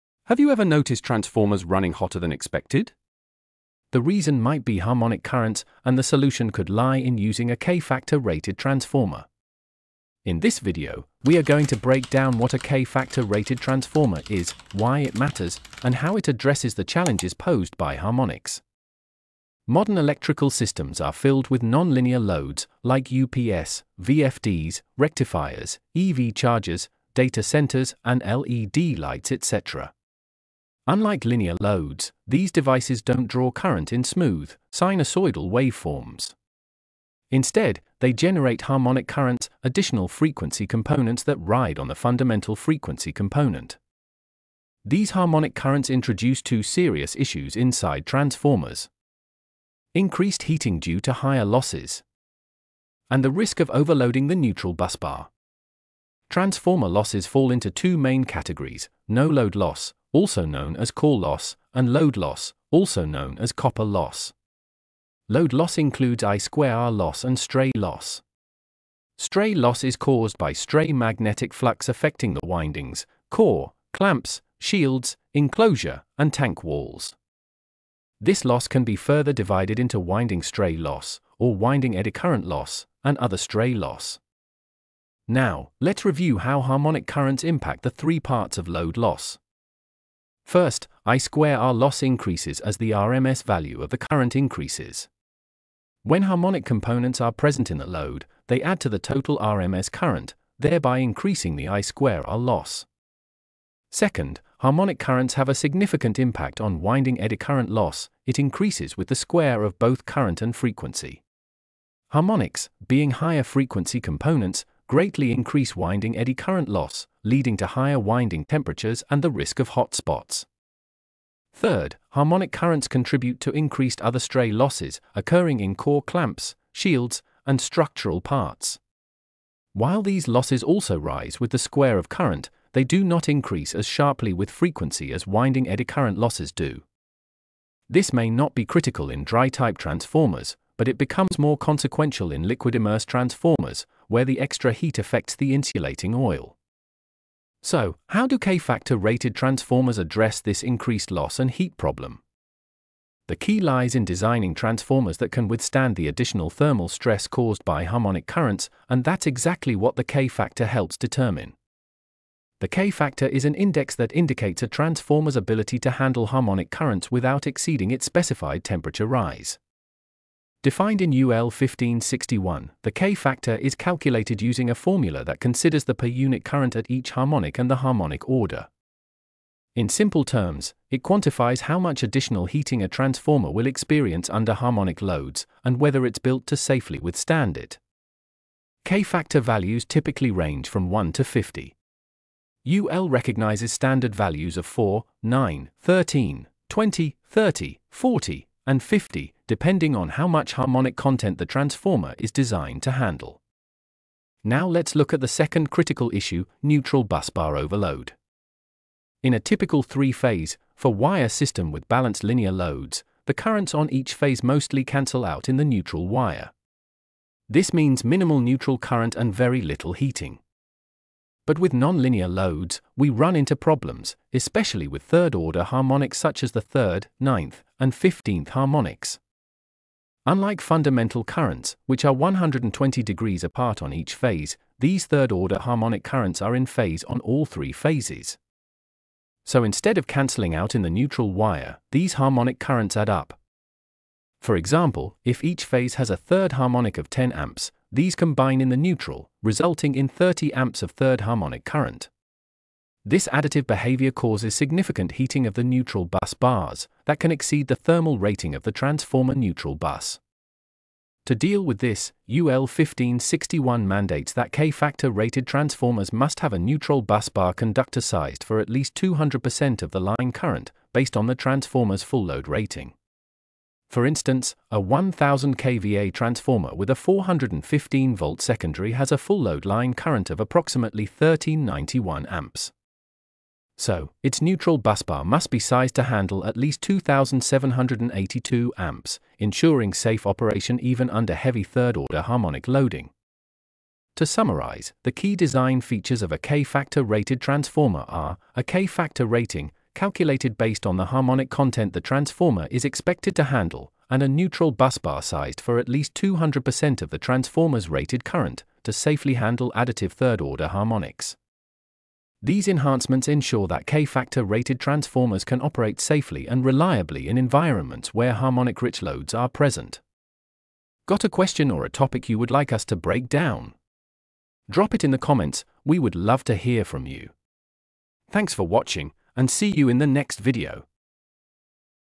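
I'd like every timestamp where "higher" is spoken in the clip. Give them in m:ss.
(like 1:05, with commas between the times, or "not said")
0:51, 1:53, 1:57.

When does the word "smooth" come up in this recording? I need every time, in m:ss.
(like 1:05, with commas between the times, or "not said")
0:34.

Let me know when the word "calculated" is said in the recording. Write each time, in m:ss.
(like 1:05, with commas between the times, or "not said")
2:53, 4:59.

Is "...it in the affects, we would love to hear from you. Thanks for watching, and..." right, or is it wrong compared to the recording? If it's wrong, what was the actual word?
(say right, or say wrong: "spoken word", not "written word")
wrong: "comments", not "affects".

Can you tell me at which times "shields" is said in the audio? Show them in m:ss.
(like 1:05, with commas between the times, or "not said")
1:14, 2:06.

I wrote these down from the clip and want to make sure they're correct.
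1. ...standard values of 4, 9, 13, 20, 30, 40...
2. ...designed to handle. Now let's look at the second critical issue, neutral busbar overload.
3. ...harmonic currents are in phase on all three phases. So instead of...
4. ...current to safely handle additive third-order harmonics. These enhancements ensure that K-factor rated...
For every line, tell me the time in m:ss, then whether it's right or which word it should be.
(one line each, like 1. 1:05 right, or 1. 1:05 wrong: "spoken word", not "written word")
1. 3:13 right
2. 3:22 right
3. 3:55 right
4. 5:08 right.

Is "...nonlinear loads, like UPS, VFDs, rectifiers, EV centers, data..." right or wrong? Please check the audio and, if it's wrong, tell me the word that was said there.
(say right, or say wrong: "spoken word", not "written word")
wrong: "chargers", not "centers".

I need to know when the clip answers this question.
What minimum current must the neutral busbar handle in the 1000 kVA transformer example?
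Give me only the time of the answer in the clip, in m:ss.
4:46.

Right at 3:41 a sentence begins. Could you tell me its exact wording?
But with nonlinear loads, we run into problems, especially with third-order harmonics such as the third, ninth, and fifteenth harmonics.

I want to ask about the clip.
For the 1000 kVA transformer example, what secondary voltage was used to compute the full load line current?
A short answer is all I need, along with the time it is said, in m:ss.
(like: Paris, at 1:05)
415 volts, at 4:36.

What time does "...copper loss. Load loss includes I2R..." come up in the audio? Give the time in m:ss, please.
1:03.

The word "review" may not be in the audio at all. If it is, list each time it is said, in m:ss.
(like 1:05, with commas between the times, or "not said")
1:26.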